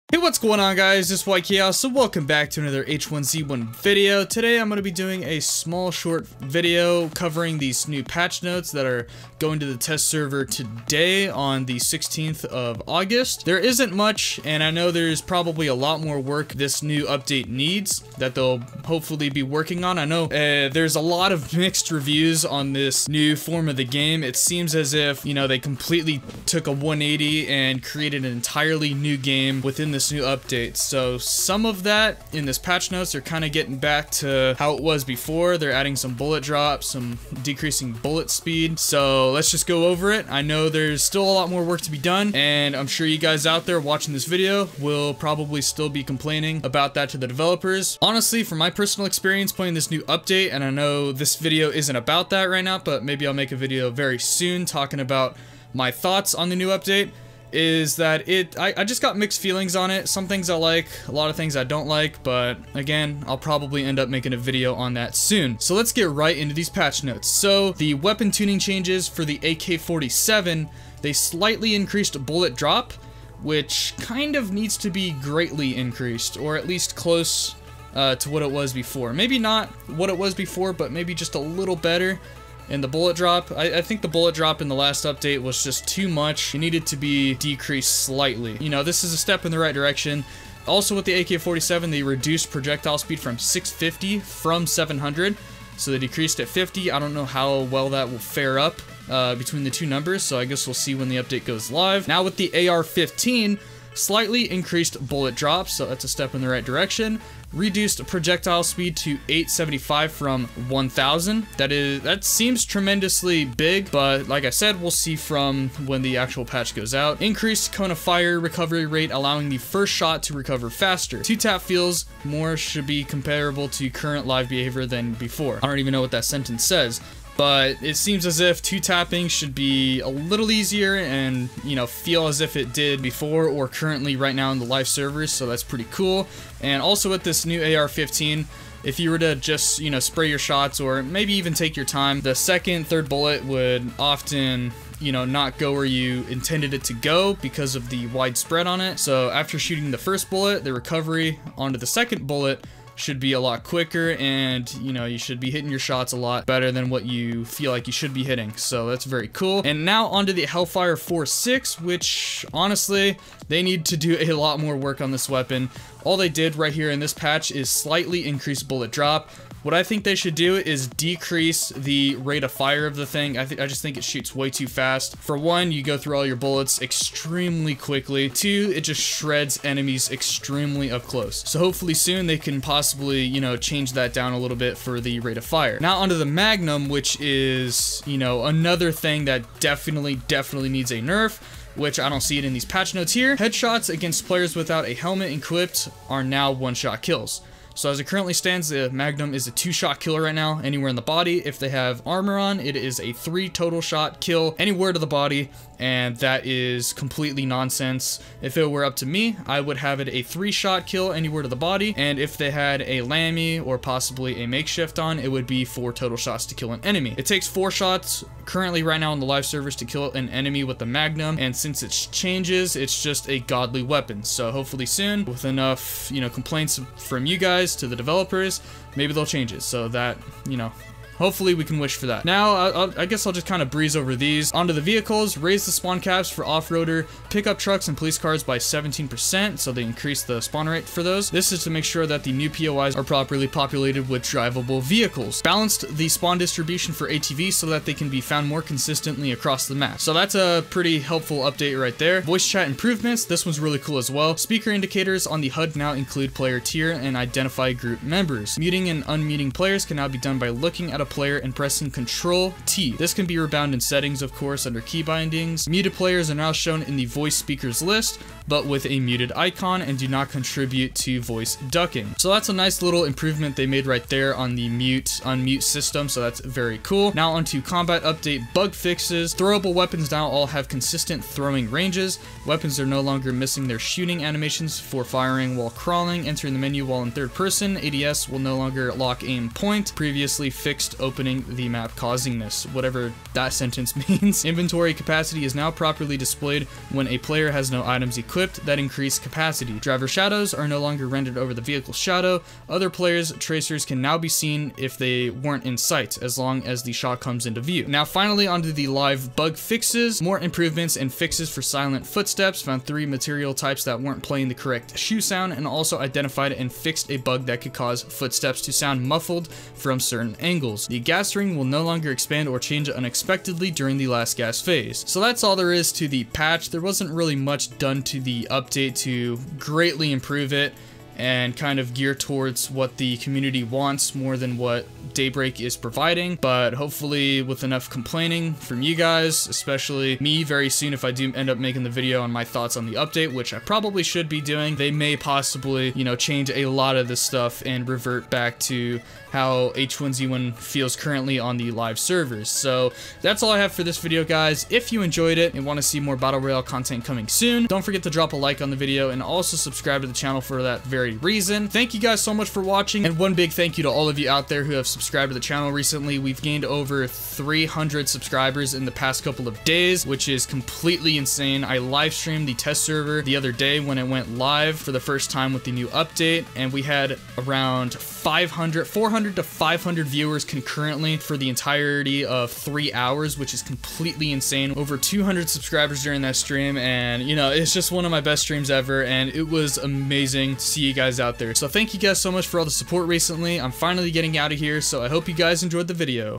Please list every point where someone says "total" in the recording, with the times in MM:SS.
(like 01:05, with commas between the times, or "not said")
03:23, 03:35.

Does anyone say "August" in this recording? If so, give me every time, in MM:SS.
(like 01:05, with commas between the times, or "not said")
00:12.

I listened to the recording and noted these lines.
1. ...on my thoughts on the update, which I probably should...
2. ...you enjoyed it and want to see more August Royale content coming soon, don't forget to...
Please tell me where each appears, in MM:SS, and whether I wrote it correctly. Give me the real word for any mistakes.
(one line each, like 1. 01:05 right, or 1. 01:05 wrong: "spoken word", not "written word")
1. 05:42 right
2. 05:54 wrong: "Battle", not "August".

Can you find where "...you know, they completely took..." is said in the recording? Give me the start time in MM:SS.
00:25.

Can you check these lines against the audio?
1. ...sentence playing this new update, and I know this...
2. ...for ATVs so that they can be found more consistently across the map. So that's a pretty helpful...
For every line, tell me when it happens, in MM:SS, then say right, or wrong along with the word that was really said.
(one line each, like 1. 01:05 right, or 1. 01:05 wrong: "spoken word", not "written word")
1. 00:49 wrong: "experience", not "sentence"
2. 04:06 right.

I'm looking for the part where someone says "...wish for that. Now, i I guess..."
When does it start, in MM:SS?
03:51.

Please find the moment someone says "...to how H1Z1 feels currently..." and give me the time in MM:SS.
05:48.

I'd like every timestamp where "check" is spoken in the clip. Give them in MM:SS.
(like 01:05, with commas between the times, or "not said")
not said.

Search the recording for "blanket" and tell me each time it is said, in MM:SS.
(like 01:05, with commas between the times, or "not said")
not said.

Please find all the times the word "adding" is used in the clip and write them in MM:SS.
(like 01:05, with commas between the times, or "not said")
00:35.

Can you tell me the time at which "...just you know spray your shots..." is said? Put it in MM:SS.
02:19.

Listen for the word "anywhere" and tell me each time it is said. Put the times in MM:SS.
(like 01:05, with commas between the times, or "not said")
03:20, 03:24, 03:31.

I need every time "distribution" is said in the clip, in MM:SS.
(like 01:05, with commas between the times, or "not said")
04:06.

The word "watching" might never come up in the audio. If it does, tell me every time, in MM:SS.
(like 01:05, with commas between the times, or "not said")
00:43, 06:02.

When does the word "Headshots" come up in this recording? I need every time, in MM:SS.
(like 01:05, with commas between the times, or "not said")
03:13.